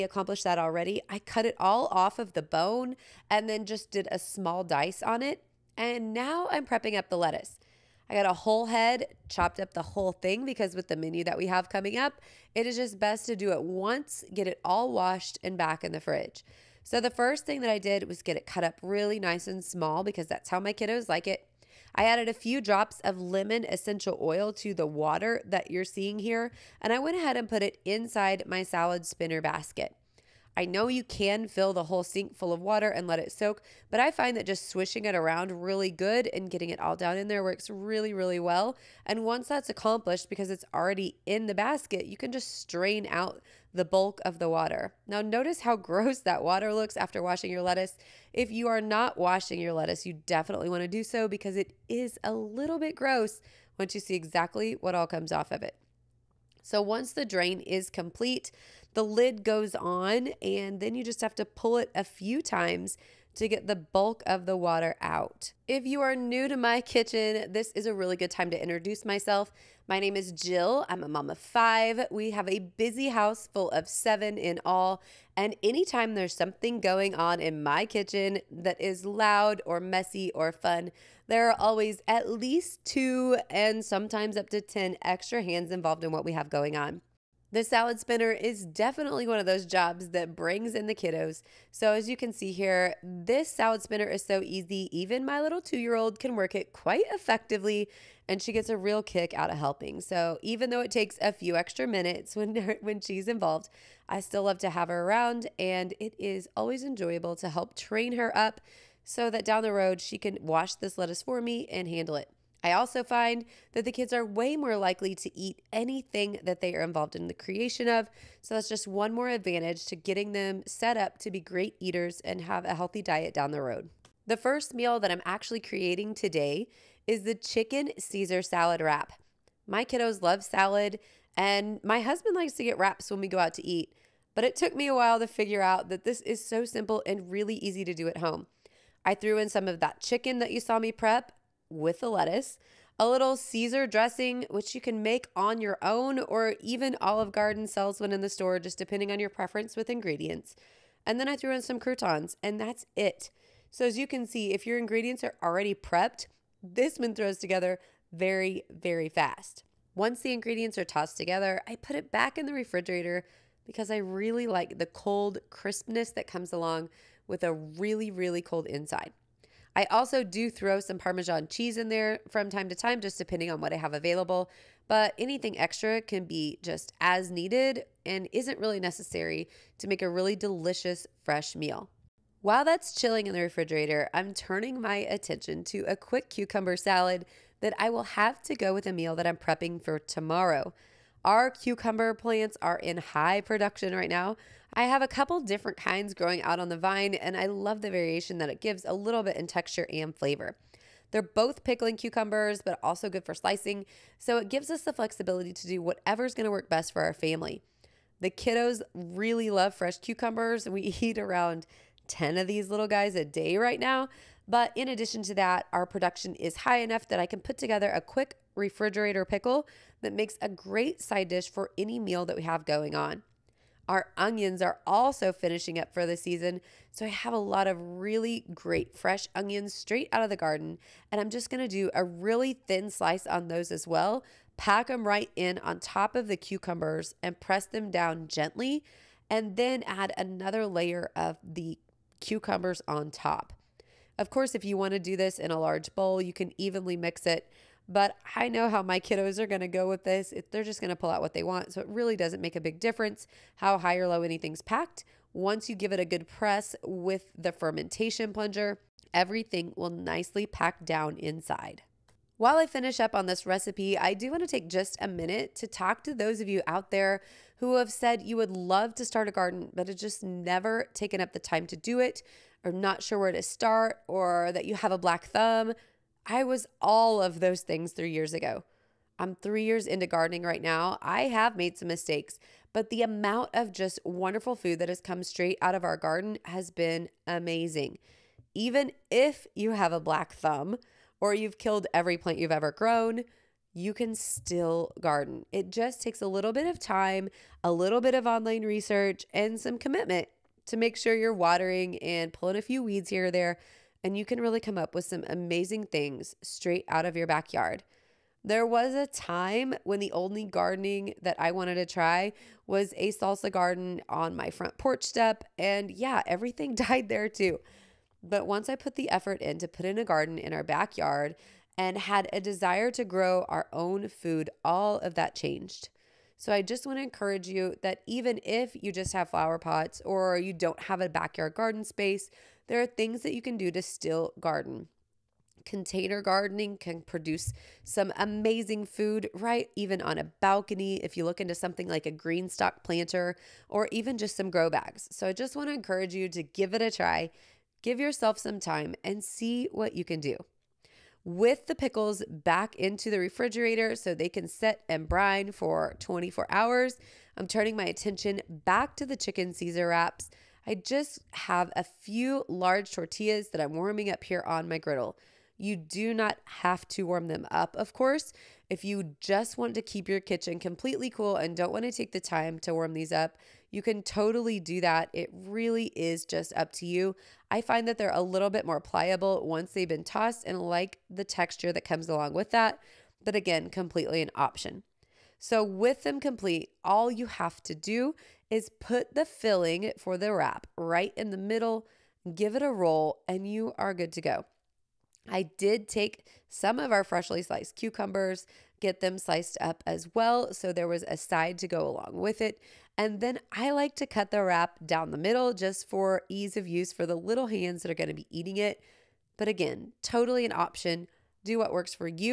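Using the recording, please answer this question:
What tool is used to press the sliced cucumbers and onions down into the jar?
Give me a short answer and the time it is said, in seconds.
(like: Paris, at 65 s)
Fermentation plunger, at 257 s.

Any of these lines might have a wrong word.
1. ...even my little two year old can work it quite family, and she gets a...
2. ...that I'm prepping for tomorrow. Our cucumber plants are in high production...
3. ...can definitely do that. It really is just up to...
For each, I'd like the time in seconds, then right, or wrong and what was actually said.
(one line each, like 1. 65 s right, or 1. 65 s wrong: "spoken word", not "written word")
1. 94 s wrong: "effectively", not "family"
2. 189 s right
3. 373 s wrong: "totally", not "definitely".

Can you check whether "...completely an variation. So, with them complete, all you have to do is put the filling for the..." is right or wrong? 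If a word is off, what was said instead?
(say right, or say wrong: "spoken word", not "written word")
wrong: "option", not "variation".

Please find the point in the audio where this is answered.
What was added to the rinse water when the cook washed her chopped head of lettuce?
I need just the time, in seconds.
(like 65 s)
23 s.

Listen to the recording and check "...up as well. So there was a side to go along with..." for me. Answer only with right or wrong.
right.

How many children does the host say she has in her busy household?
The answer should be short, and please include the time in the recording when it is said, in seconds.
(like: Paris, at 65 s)
5, at 71 s.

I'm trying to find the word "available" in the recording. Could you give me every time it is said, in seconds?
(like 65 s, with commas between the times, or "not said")
173 s.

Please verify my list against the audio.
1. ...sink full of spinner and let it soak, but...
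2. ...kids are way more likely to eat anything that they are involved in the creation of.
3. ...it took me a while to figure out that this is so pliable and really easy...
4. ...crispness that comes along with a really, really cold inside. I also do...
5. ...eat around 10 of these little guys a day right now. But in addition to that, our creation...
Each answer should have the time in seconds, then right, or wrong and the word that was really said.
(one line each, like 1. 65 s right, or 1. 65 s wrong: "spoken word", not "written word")
1. 32 s wrong: "water", not "spinner"
2. 113 s right
3. 134 s wrong: "simple", not "pliable"
4. 165 s right
5. 211 s wrong: "production", not "creation".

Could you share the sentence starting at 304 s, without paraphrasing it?
And you can really come up with some amazing things straight out of your backyard.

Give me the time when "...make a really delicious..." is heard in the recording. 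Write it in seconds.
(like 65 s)
179 s.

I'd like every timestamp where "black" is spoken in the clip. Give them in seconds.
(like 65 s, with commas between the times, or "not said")
274 s, 290 s.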